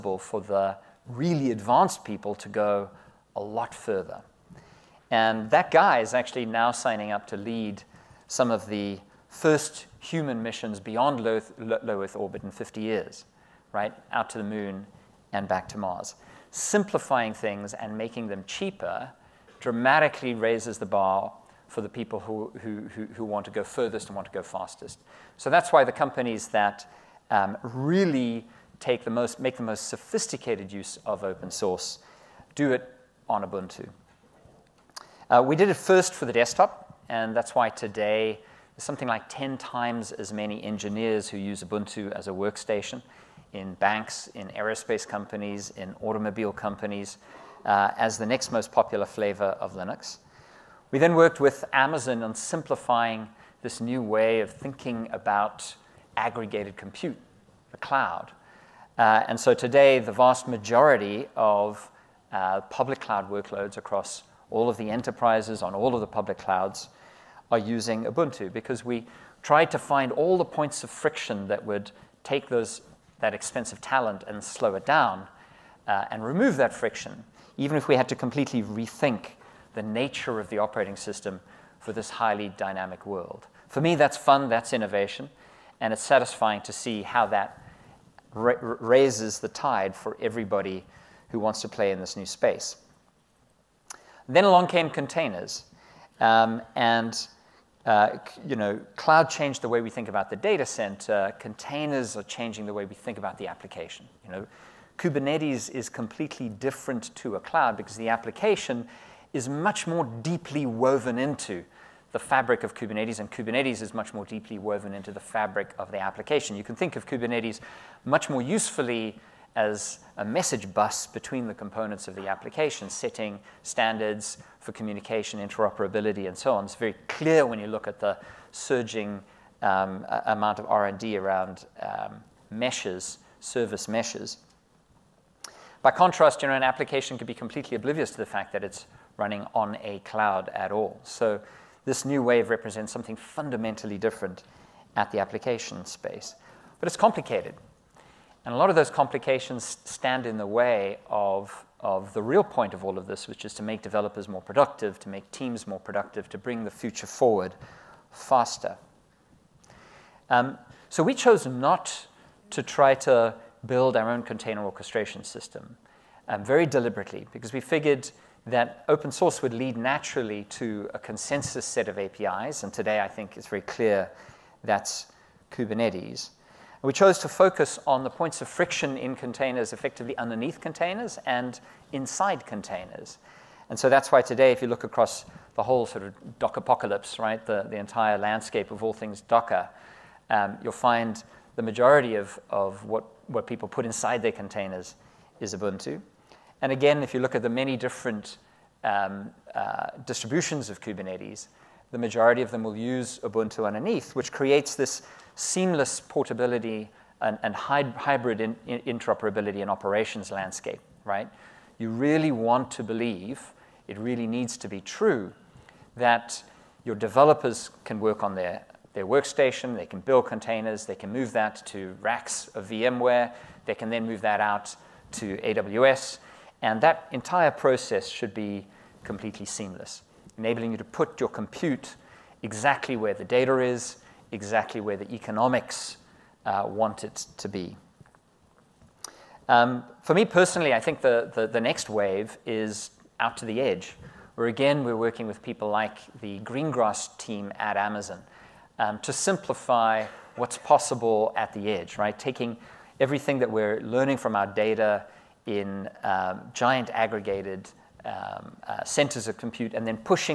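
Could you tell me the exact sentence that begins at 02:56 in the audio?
we chose to focus on the points of friction in containers, effectively underneath containers and inside containers.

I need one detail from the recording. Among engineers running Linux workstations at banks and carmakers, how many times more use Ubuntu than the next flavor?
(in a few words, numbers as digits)
10 times.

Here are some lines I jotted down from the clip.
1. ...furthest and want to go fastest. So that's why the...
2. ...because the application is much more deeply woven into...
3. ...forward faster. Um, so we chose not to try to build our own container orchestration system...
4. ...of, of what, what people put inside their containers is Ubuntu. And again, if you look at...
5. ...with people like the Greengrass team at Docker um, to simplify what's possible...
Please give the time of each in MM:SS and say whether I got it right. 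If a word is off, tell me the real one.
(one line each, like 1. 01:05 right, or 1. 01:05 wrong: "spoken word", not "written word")
1. 00:23 right
2. 01:47 right
3. 02:37 right
4. 03:12 right
5. 04:05 wrong: "Amazon", not "Docker".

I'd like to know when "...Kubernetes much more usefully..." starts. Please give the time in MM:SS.
01:57.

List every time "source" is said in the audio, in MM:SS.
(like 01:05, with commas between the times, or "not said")
00:31, 02:49.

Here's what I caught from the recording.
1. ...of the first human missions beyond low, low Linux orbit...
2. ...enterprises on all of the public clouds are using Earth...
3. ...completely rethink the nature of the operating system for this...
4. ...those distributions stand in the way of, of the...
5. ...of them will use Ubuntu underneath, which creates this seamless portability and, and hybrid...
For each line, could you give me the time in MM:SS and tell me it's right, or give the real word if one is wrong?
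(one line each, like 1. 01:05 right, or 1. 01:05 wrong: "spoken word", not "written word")
1. 00:08 wrong: "Earth", not "Linux"
2. 01:04 wrong: "Ubuntu", not "Earth"
3. 01:18 right
4. 02:28 wrong: "complications", not "distributions"
5. 03:22 right.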